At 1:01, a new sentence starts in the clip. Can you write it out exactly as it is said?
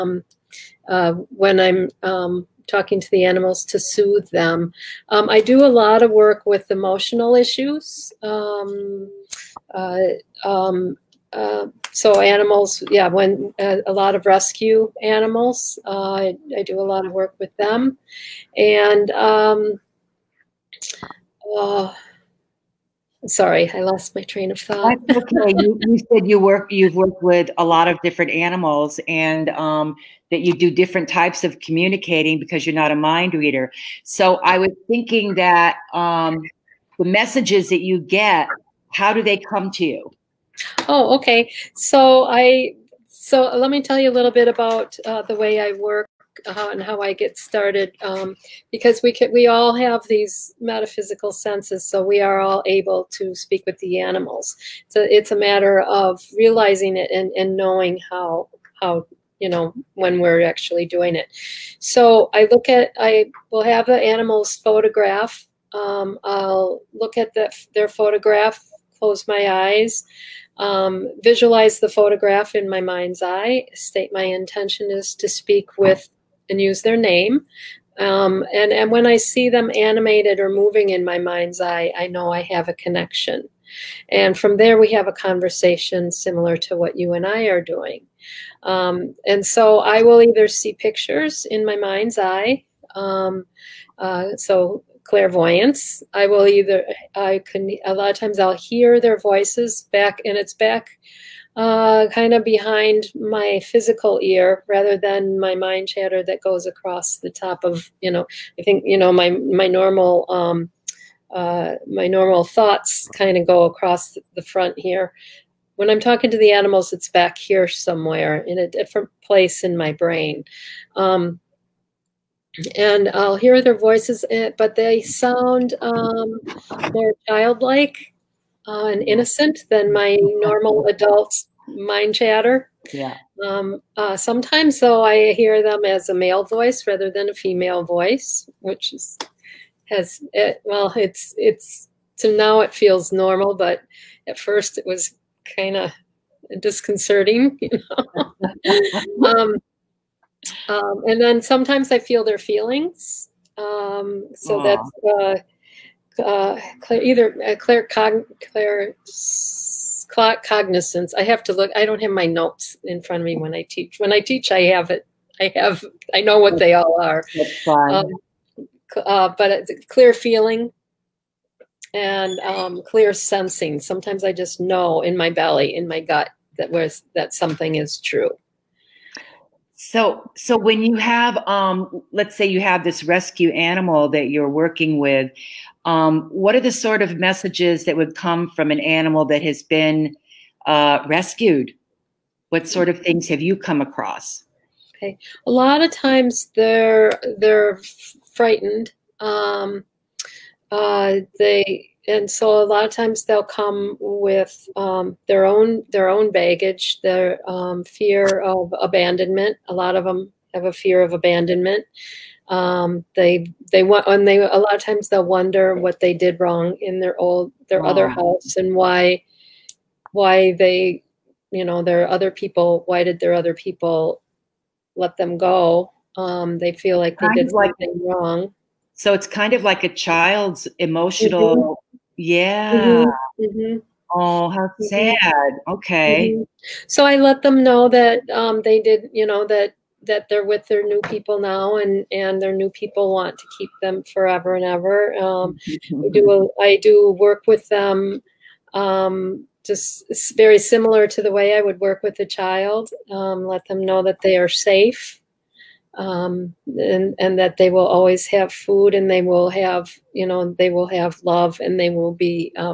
So I look at I will have the animals photograph.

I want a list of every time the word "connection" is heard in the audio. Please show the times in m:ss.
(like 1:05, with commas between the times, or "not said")
1:22.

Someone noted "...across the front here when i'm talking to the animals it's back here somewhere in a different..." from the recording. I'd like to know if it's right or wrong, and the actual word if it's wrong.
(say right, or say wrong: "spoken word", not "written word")
right.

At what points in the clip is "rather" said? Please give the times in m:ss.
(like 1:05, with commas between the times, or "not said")
1:44, 2:16.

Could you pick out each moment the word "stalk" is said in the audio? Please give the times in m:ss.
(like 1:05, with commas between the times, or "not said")
not said.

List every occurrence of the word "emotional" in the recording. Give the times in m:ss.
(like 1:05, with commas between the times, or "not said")
0:06, 3:50.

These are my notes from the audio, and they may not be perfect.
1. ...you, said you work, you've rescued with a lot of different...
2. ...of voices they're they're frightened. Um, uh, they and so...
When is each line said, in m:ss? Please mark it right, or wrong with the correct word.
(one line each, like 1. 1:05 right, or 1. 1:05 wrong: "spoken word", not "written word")
1. 0:25 wrong: "worked", not "rescued"
2. 3:15 wrong: "times", not "voices".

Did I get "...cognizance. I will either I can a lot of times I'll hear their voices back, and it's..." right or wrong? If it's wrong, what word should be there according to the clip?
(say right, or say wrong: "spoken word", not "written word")
wrong: "clairvoyance", not "cognizance".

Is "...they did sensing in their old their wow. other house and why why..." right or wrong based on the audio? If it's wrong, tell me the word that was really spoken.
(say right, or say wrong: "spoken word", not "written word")
wrong: "wrong", not "sensing".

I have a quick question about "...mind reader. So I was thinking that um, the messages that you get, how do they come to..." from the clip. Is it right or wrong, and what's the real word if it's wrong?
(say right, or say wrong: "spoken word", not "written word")
right.